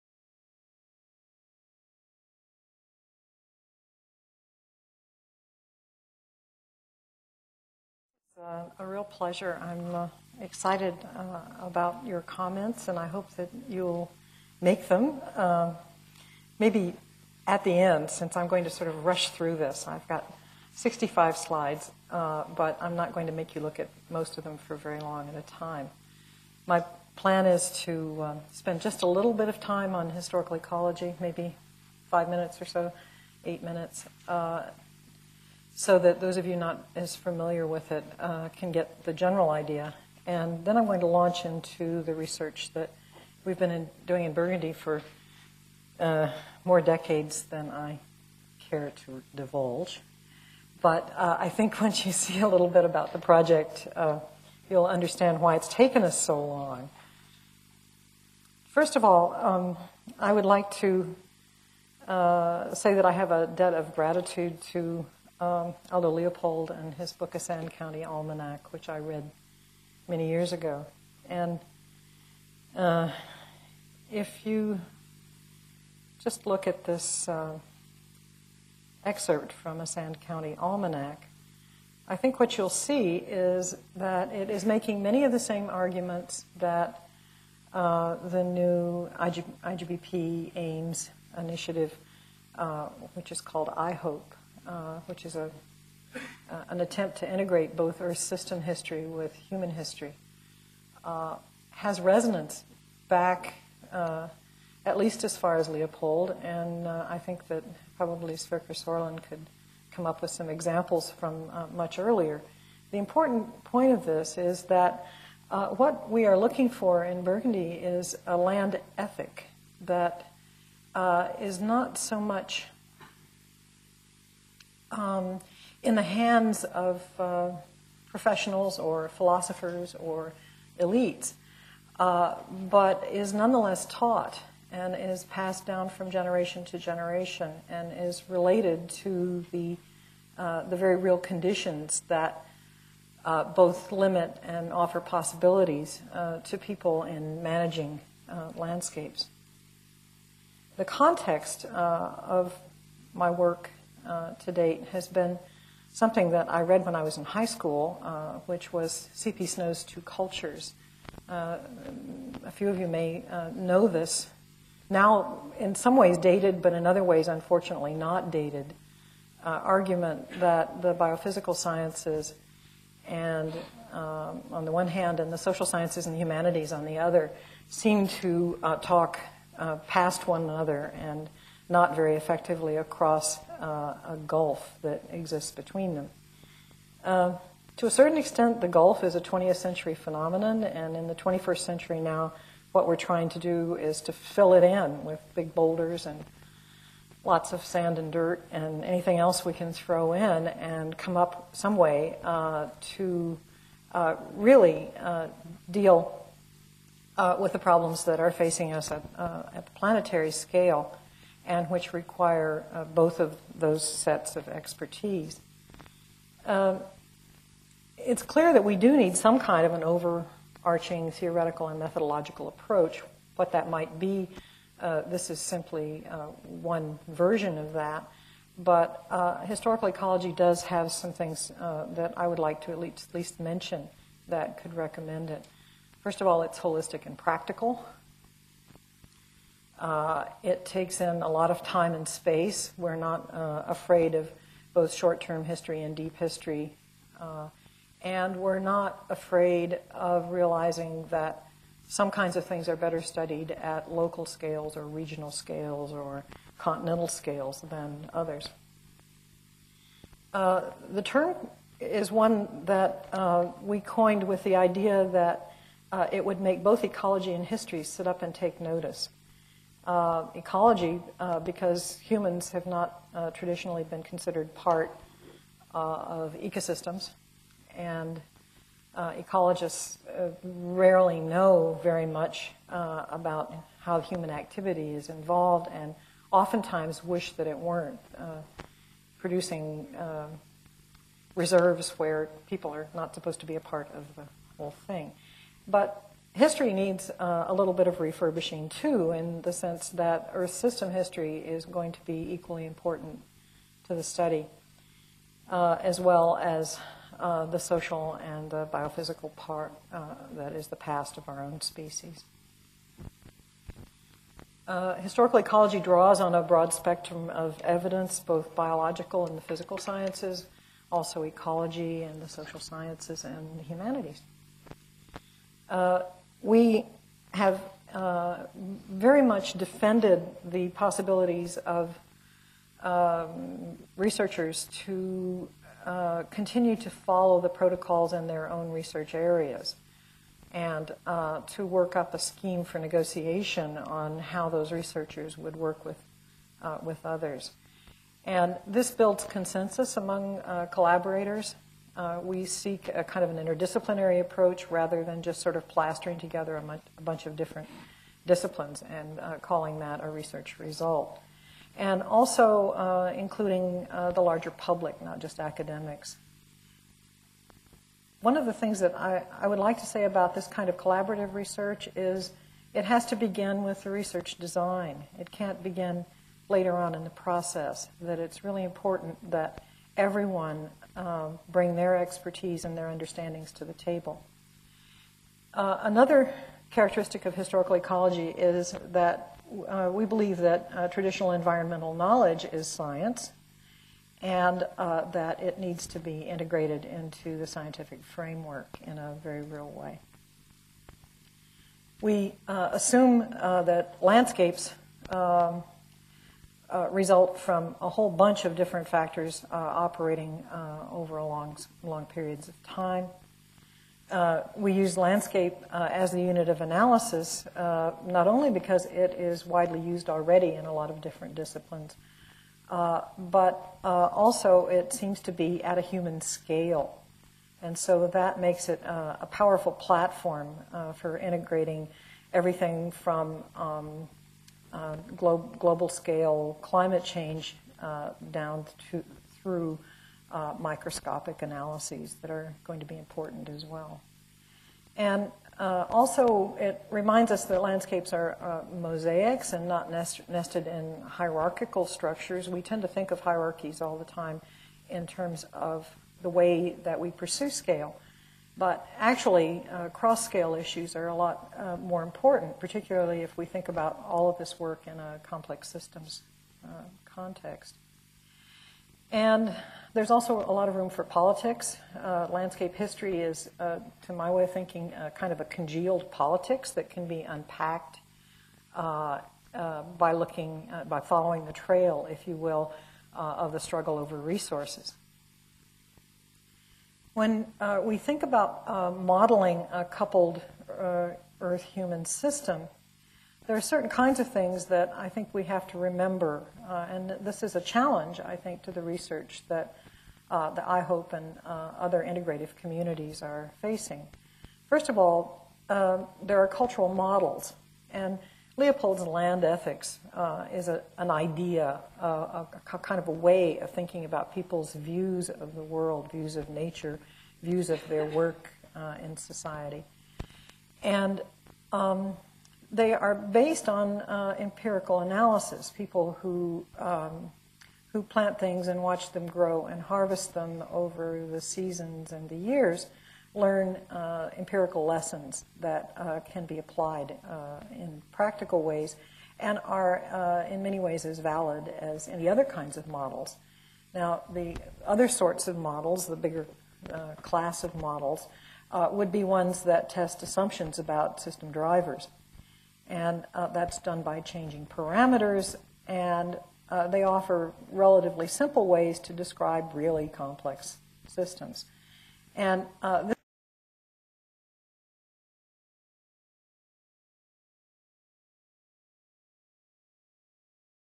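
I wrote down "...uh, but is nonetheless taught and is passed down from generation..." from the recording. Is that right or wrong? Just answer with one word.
right.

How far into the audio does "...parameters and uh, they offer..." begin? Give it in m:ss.
9:14.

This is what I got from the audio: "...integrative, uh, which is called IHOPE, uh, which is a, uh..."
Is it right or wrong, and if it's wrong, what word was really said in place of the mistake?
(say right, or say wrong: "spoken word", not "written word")
wrong: "initiative", not "integrative".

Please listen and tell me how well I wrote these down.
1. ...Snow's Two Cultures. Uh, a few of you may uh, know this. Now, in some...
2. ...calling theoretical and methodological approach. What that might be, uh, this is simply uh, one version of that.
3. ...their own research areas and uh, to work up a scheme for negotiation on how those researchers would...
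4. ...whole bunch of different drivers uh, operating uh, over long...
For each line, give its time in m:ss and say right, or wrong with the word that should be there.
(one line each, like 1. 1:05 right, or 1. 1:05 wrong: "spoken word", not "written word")
1. 2:39 right
2. 3:39 wrong: "overarching", not "calling"
3. 5:38 right
4. 6:47 wrong: "factors", not "drivers".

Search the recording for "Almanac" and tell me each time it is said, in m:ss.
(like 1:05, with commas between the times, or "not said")
1:08, 1:20.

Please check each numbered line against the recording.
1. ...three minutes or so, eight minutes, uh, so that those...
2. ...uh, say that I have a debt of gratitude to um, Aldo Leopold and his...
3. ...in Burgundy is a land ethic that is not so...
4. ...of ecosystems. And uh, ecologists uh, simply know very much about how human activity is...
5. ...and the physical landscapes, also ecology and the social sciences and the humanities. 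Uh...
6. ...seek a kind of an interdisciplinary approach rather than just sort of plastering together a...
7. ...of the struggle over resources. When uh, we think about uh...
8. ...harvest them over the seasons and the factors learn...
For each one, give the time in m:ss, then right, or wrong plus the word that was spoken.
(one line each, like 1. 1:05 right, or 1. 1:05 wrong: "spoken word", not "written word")
1. 0:32 wrong: "five", not "three"
2. 1:02 right
3. 1:57 right
4. 4:35 wrong: "rarely", not "simply"
5. 5:19 wrong: "sciences", not "landscapes"
6. 5:52 right
7. 8:03 right
8. 8:49 wrong: "years", not "factors".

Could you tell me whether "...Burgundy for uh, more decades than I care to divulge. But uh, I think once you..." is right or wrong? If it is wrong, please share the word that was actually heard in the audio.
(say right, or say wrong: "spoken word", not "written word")
right.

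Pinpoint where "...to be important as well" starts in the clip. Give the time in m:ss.
7:22.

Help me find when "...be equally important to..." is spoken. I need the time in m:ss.
5:02.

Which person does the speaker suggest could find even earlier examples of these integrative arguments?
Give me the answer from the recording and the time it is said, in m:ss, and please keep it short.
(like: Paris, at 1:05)
Sverker Sorlin, at 1:48.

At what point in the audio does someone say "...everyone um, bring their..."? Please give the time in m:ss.
6:19.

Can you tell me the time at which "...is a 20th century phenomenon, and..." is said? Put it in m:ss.
3:09.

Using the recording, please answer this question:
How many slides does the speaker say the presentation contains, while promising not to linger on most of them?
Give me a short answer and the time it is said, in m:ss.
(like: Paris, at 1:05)
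65, at 0:20.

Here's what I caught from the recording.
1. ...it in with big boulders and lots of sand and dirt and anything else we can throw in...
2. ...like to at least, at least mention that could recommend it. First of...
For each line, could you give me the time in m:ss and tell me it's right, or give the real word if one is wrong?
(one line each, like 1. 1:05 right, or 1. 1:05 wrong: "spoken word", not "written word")
1. 3:14 right
2. 3:52 right.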